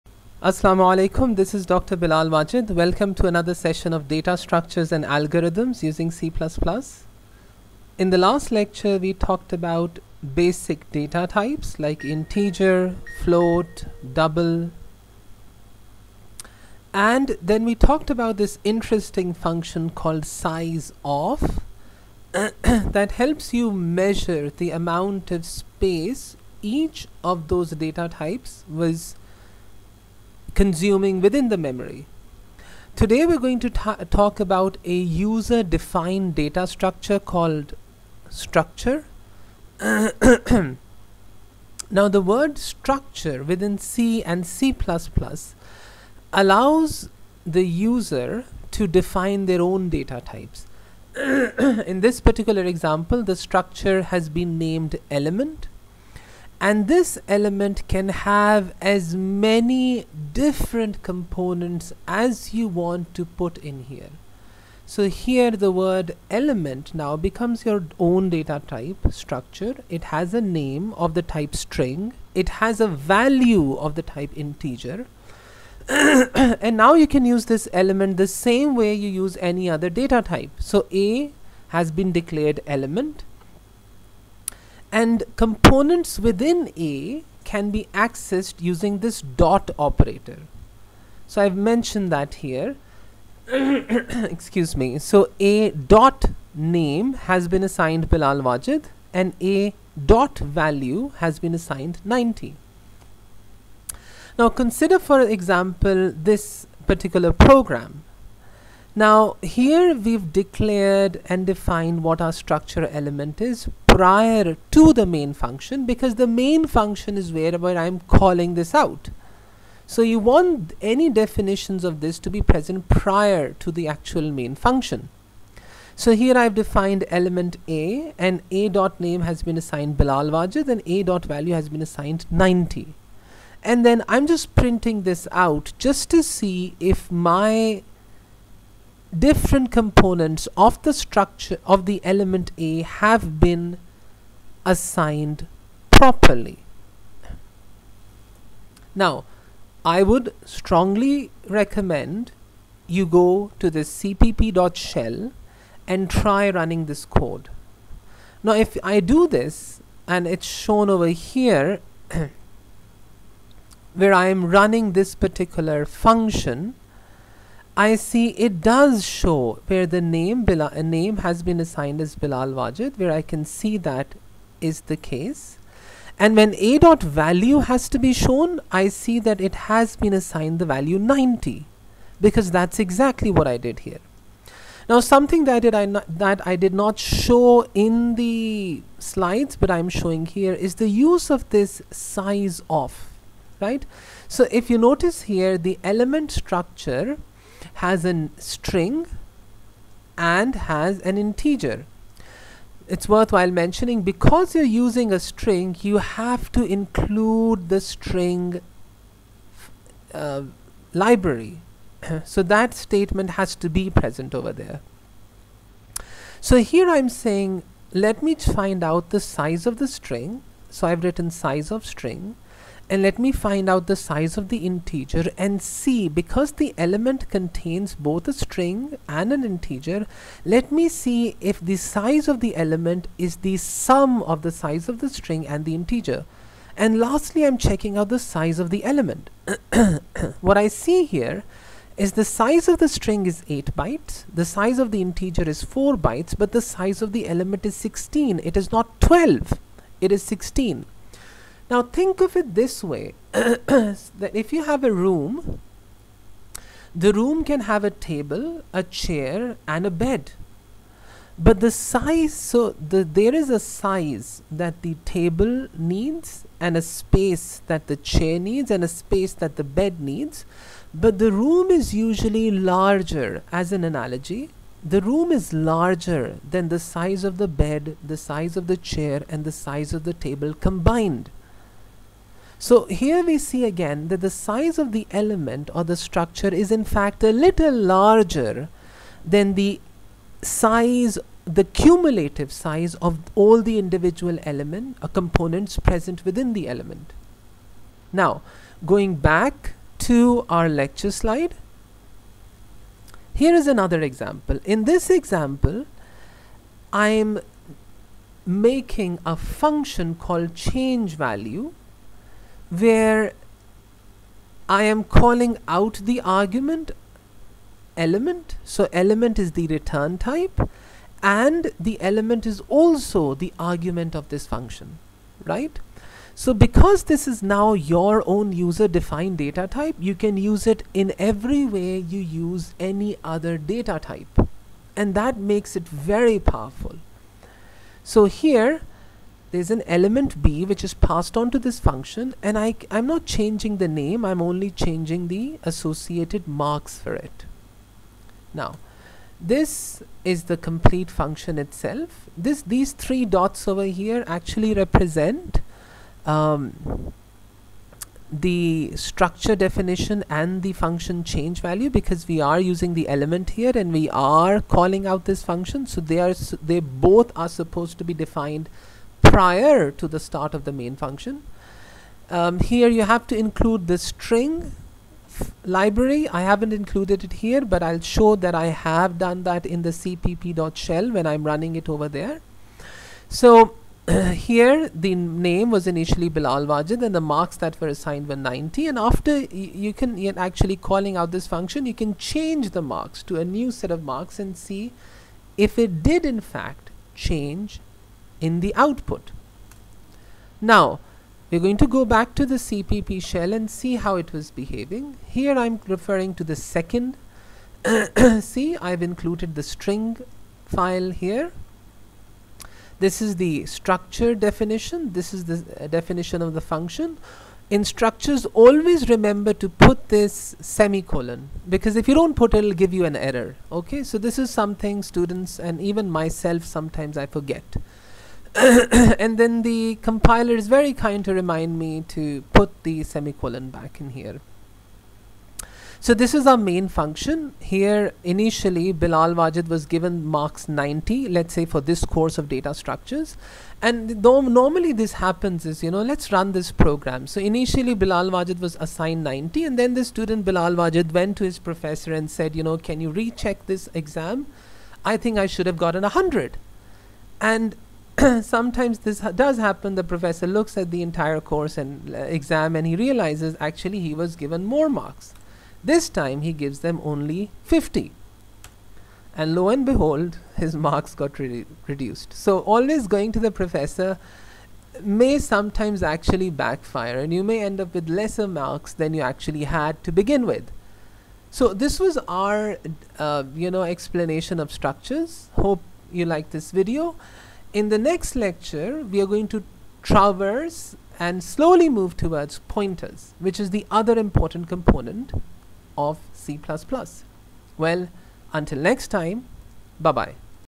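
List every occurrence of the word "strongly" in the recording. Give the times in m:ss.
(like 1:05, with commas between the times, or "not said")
2:30.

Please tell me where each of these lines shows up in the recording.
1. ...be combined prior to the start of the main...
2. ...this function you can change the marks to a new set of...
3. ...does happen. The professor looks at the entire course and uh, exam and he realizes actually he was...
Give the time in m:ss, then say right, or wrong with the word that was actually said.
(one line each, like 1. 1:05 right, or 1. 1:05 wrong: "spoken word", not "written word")
1. 6:08 wrong: "defined", not "combined"
2. 6:31 right
3. 7:39 right.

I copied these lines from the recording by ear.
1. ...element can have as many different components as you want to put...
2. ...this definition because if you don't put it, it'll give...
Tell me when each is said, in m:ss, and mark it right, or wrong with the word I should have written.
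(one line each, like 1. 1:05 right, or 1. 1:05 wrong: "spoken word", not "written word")
1. 0:57 right
2. 7:00 wrong: "semicolon", not "definition".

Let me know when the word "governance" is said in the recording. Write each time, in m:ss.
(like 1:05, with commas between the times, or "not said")
not said.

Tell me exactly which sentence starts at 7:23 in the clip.
And though normally this happens is, you know, let's run this program.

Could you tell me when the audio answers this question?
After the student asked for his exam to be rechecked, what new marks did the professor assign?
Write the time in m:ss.
7:47.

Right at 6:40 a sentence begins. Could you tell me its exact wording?
Now, we're going to go back to the CPP shell and see how it was behaving.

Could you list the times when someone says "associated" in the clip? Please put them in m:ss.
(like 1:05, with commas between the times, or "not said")
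5:45.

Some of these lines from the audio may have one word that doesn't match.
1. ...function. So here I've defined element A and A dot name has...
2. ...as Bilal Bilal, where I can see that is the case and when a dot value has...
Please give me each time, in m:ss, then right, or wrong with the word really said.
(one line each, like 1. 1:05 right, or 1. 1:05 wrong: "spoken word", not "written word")
1. 2:04 right
2. 2:52 wrong: "Wajid", not "Bilal".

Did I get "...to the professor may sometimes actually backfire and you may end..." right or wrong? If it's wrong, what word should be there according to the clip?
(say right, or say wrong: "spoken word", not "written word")
right.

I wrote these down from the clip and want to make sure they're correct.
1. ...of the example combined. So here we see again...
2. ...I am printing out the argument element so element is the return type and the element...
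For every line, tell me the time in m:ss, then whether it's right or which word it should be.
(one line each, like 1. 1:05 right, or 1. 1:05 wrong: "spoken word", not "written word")
1. 4:39 wrong: "table", not "example"
2. 5:14 wrong: "calling", not "printing".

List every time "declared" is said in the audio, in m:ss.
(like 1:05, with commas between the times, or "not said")
1:22, 1:50.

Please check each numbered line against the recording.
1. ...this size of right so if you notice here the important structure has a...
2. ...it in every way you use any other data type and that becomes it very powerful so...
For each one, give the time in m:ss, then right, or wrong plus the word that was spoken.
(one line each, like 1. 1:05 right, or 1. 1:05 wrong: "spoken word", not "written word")
1. 3:11 wrong: "element", not "important"
2. 5:30 wrong: "makes", not "becomes".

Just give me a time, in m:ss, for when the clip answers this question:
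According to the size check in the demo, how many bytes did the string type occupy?
4:03.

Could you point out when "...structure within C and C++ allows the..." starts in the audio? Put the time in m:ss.
0:42.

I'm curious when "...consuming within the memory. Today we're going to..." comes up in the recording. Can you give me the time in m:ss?
0:30.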